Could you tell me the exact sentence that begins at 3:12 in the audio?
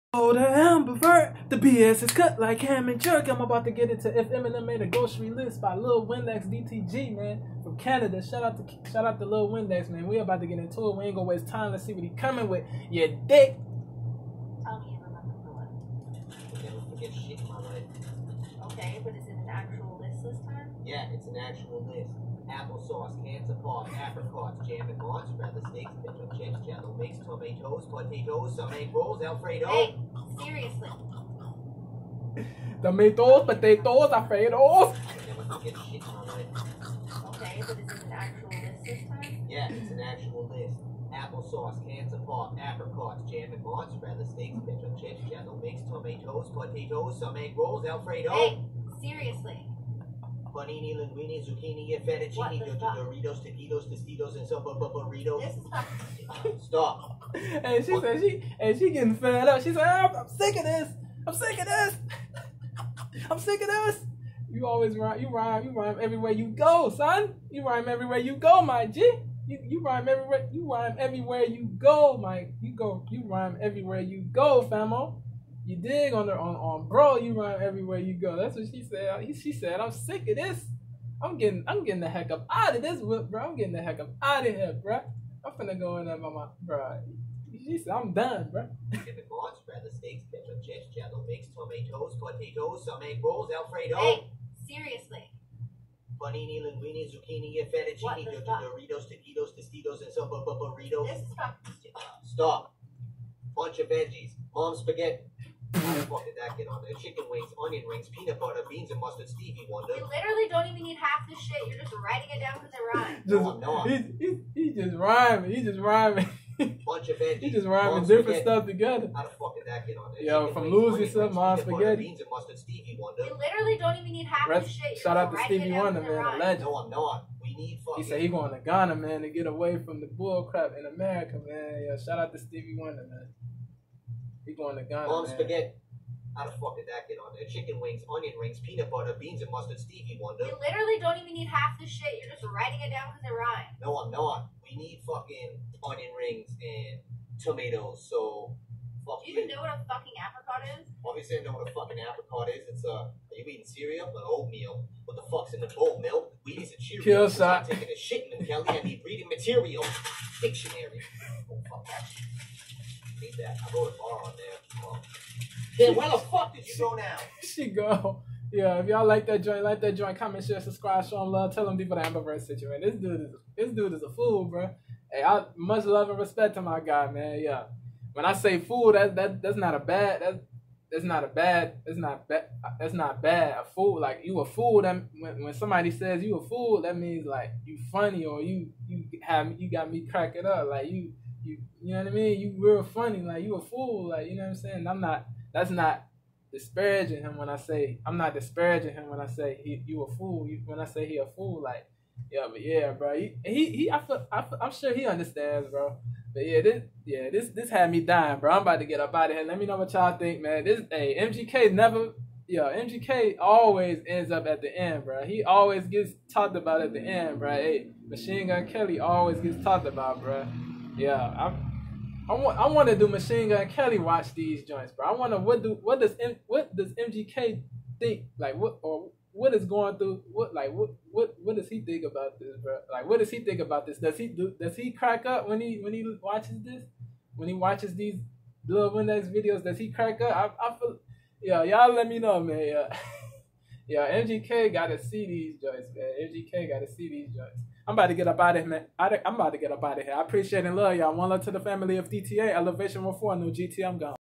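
You real funny, like you a fool, like you know what I'm saying?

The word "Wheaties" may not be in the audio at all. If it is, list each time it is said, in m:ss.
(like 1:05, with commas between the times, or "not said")
2:36.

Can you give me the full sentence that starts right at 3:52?
Like what does he think about this?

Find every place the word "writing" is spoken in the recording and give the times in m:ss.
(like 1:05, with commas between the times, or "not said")
1:52, 2:22.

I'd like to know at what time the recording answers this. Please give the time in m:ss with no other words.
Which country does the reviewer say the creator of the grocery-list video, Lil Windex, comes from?
0:07.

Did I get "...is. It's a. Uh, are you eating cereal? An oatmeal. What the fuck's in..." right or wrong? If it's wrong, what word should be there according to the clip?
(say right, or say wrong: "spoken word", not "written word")
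right.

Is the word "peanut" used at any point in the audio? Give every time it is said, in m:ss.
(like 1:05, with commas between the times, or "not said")
1:48, 2:18.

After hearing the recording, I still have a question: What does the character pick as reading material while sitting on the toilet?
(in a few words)
Dictionary.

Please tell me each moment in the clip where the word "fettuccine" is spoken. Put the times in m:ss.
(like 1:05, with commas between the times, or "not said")
0:52, 1:37.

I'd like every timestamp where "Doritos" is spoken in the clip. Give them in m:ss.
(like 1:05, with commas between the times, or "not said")
0:52, 1:38.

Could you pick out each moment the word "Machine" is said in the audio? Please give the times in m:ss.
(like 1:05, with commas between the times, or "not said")
3:38, 3:43.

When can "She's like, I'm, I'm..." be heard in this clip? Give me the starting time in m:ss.
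0:59.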